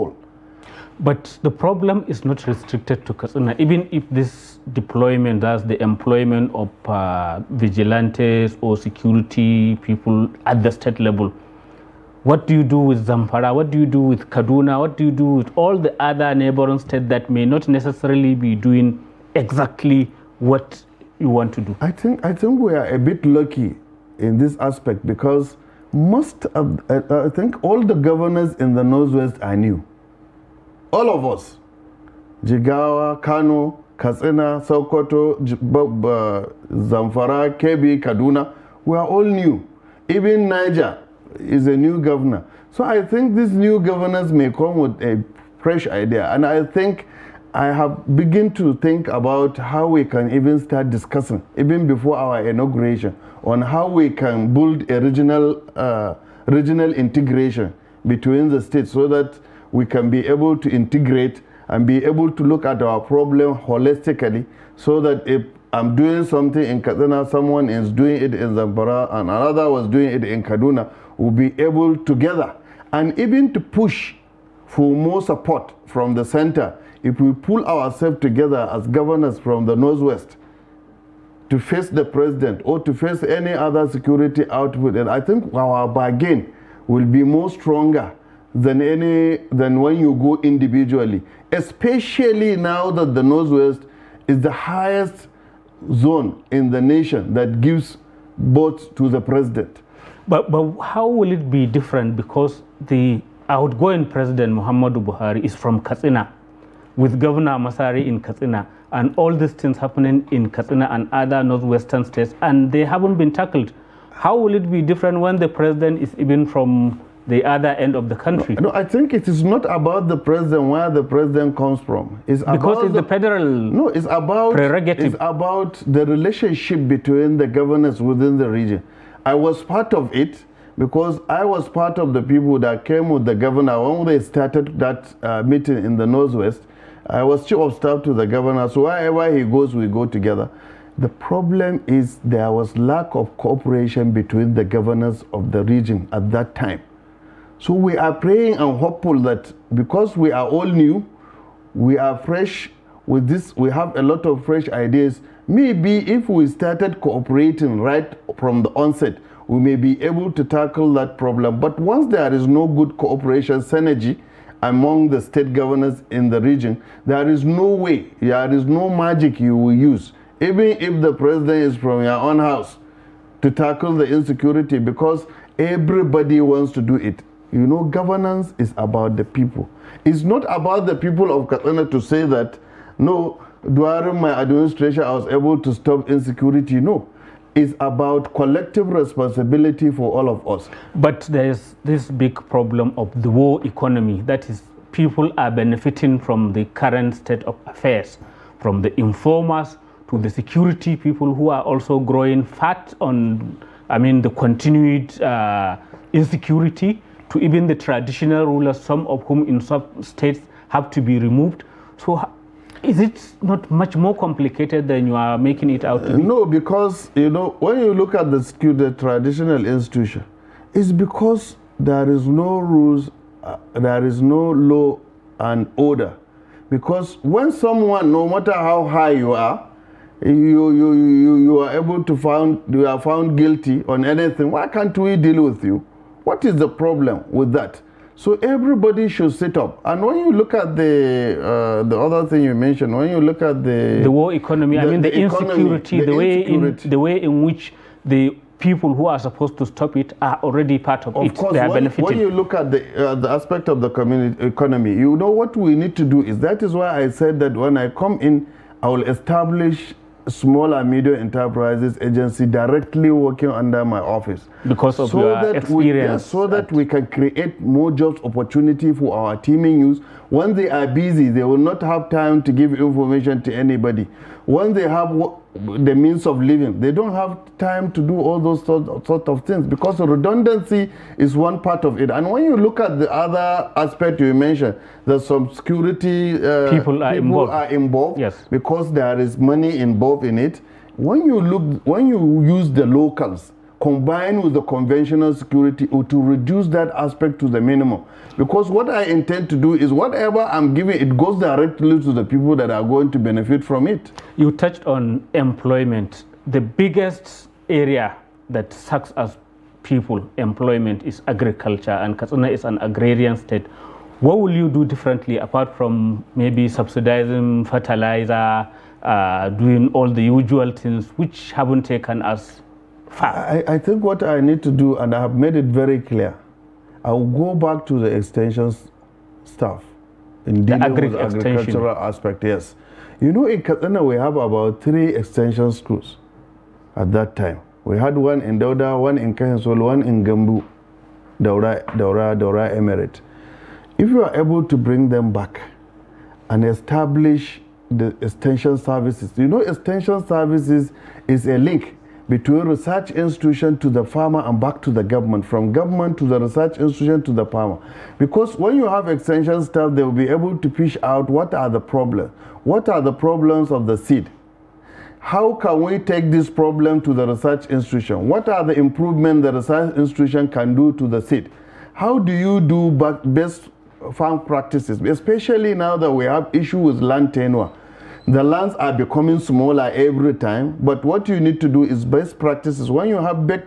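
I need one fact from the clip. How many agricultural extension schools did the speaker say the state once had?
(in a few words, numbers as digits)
3.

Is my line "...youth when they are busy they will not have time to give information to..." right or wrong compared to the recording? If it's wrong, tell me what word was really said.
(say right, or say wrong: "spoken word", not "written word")
right.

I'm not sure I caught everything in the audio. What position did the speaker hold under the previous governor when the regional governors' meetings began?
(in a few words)
Chief of staff.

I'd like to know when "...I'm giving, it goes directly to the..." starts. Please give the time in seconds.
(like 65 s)
300 s.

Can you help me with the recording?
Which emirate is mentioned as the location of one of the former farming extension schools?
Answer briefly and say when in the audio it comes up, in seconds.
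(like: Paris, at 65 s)
Daura Emirate, at 342 s.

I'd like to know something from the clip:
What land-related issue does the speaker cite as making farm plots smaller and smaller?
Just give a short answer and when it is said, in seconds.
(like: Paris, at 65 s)
Land tenure, at 377 s.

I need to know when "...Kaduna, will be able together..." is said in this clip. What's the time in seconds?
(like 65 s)
70 s.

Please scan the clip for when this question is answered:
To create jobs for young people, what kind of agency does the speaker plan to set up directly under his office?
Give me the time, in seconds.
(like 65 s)
260 s.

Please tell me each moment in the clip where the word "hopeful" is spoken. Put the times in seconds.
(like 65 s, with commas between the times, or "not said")
148 s.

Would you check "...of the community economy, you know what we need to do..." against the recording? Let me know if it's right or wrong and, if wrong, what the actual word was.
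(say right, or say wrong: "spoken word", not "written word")
right.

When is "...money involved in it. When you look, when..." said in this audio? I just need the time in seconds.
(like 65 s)
289 s.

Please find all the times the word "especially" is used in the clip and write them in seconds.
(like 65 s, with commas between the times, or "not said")
91 s, 375 s.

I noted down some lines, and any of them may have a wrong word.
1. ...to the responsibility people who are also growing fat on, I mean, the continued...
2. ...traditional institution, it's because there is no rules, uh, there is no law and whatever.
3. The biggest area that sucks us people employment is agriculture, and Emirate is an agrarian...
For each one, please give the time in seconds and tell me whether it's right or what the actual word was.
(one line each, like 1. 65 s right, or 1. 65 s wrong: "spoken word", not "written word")
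1. 200 s wrong: "security", not "responsibility"
2. 218 s wrong: "order", not "whatever"
3. 306 s wrong: "Katsina", not "Emirate".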